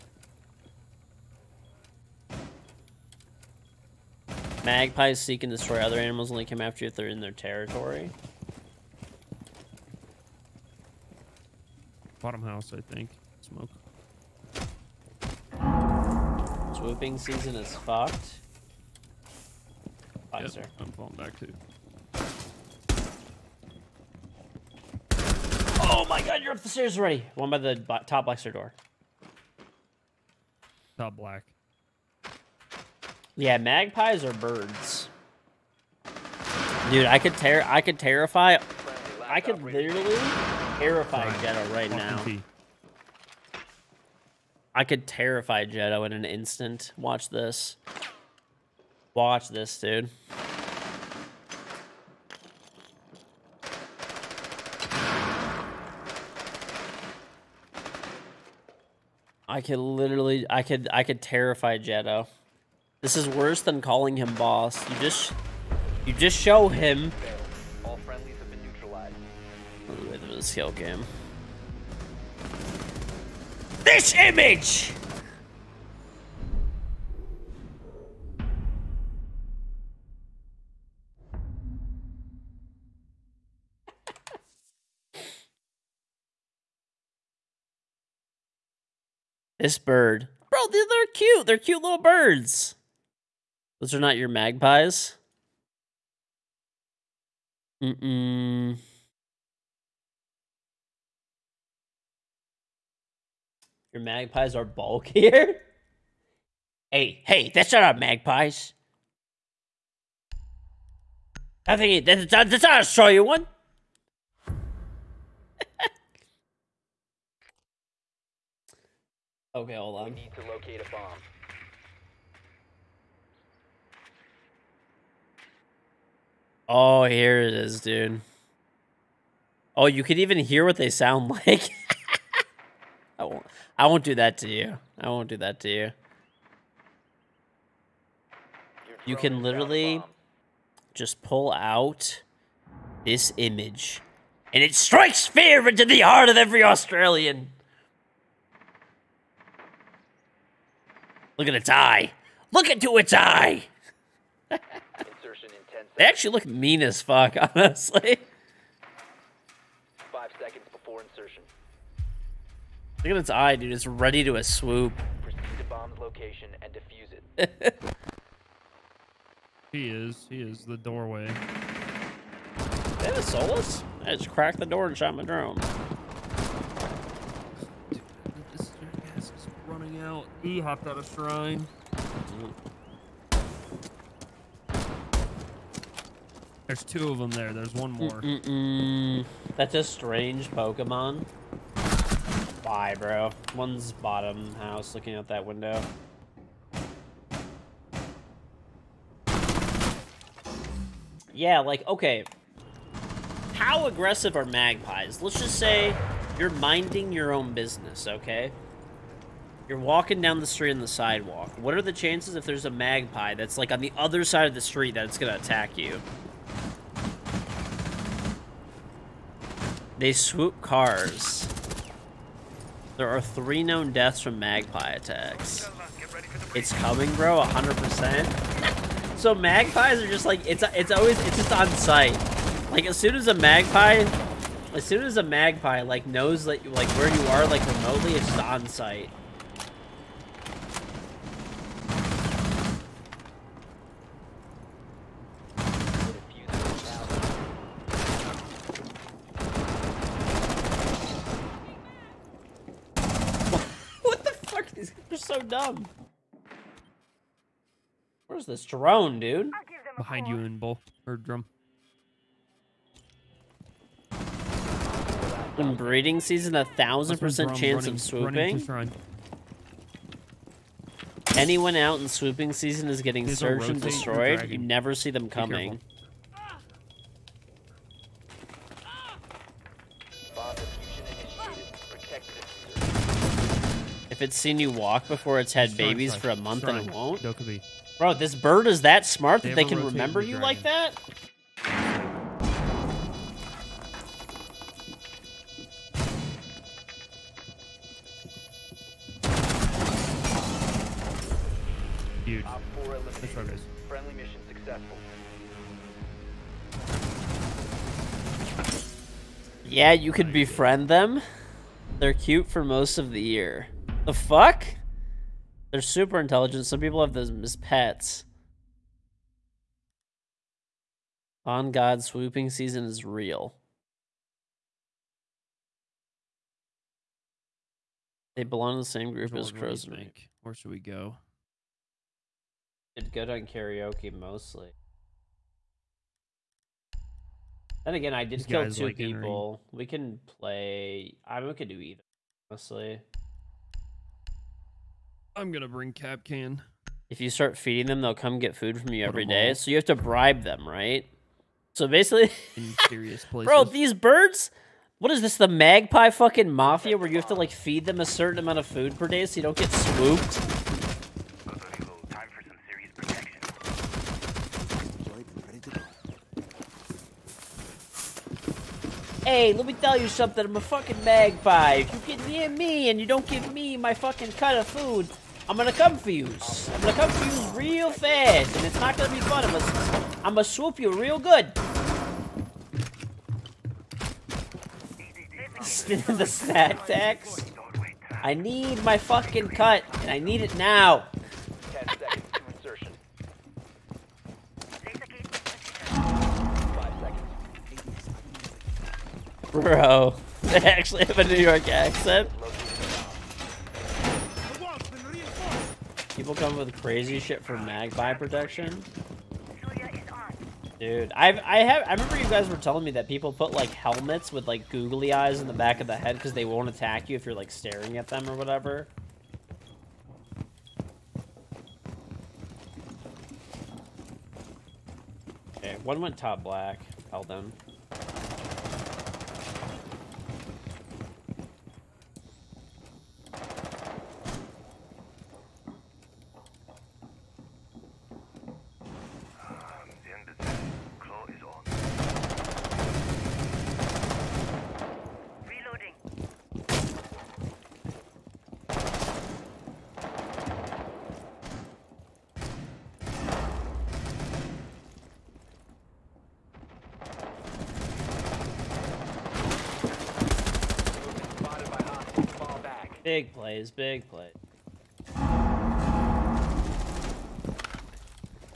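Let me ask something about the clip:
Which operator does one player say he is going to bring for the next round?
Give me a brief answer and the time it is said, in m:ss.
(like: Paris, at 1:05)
Kapkan, at 5:45.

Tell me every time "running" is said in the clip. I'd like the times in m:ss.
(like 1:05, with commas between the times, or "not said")
2:59, 4:27.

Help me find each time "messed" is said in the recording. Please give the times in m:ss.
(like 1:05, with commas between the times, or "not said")
not said.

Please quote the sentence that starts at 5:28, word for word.
They belong to the same group George, as crows.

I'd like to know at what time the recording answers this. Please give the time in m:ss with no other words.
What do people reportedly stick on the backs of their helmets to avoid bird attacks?
6:54.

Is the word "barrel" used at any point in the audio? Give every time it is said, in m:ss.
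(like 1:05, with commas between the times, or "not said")
not said.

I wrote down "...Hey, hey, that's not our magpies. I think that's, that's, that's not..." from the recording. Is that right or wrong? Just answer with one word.
right.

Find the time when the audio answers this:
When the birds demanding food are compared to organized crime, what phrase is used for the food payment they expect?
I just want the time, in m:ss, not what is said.
6:25.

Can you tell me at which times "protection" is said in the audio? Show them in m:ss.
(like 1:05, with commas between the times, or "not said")
6:48.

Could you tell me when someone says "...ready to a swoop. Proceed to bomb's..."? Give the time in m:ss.
2:43.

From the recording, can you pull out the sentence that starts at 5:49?
So you have to bribe them, right?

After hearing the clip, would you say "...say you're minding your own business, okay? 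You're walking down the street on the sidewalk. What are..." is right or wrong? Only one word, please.
right.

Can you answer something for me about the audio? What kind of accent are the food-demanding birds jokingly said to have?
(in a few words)
New York accent.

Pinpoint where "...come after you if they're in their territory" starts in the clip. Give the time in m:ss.
0:06.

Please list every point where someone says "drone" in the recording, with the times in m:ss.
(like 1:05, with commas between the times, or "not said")
2:55, 4:18.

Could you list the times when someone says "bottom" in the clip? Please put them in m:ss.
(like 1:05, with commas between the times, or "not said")
0:12, 3:13.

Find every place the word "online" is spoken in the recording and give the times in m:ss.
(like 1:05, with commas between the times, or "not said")
not said.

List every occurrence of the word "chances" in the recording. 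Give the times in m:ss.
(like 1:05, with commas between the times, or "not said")
3:32, 4:27.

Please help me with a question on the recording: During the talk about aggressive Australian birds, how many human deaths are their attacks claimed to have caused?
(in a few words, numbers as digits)
3.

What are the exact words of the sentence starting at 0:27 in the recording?
One by the top black door.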